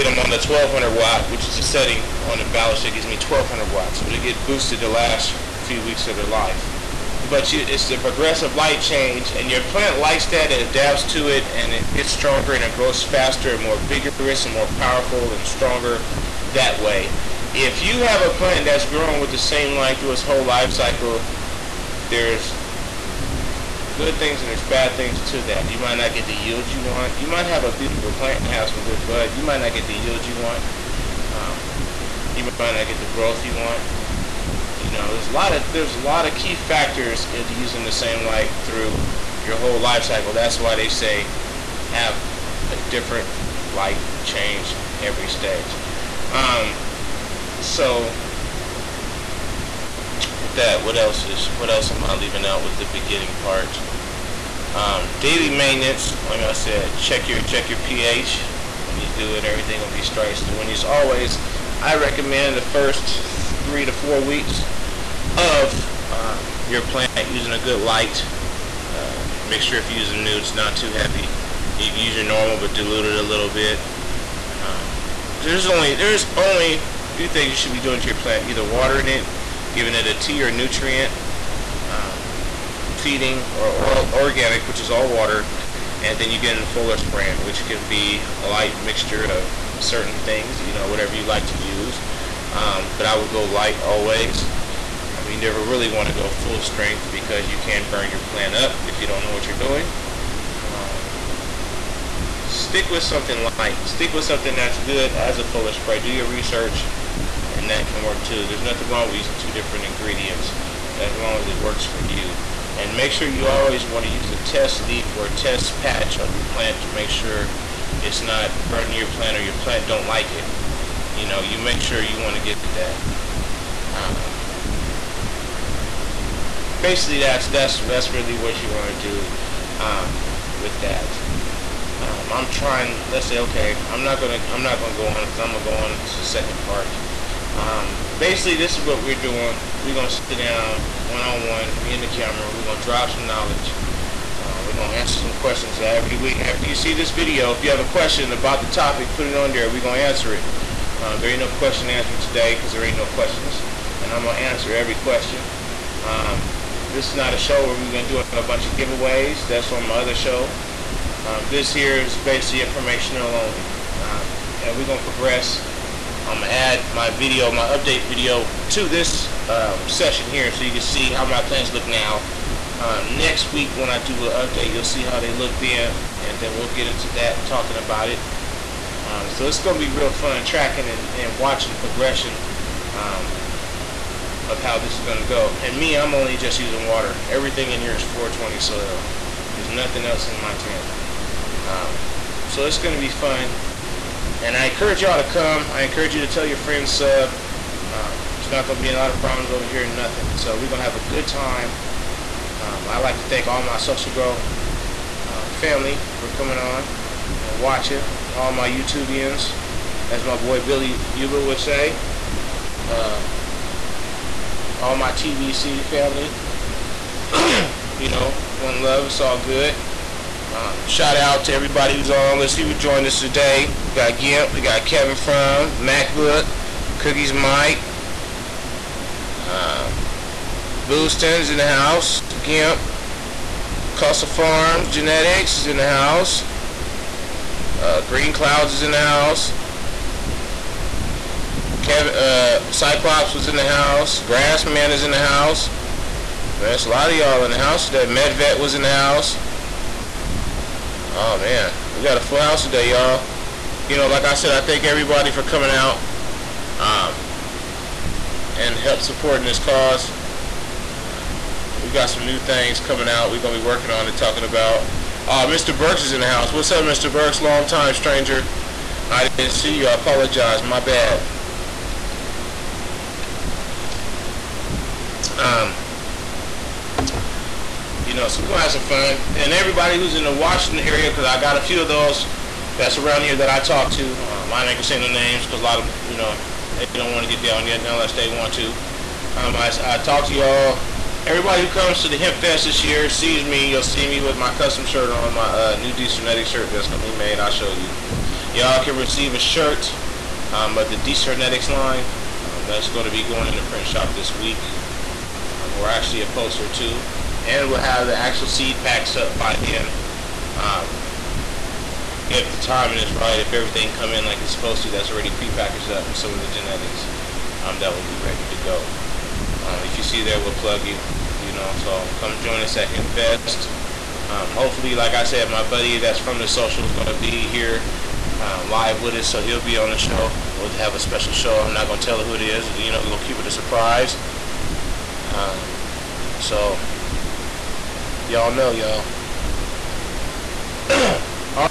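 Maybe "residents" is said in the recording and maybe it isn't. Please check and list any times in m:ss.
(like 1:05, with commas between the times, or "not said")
not said.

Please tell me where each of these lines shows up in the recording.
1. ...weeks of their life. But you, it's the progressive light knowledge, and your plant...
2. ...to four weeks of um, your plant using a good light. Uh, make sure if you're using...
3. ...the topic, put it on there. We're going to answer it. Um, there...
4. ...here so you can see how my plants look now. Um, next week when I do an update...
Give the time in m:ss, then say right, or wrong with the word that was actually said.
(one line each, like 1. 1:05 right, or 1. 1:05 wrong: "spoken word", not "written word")
1. 0:05 wrong: "change", not "knowledge"
2. 1:03 right
3. 2:28 right
4. 2:50 right.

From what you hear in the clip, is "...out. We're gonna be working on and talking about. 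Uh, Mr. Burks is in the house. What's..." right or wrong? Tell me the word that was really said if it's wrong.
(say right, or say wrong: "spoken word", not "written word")
right.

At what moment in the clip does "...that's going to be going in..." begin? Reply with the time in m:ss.
5:02.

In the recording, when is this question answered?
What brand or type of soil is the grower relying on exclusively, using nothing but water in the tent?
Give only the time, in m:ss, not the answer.
3:08.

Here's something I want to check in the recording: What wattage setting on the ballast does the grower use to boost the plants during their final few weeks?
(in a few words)
1200 watts.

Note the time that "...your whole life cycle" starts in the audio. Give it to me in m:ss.
0:39.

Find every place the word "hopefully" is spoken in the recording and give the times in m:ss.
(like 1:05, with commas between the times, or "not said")
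5:24.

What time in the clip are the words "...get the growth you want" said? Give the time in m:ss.
0:32.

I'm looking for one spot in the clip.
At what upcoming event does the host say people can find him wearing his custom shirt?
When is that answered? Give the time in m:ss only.
4:52.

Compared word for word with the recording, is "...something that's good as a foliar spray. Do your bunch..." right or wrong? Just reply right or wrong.
wrong.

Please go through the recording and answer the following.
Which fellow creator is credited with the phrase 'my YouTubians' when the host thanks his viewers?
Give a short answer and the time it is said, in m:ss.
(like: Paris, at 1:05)
Billy Uber, at 3:30.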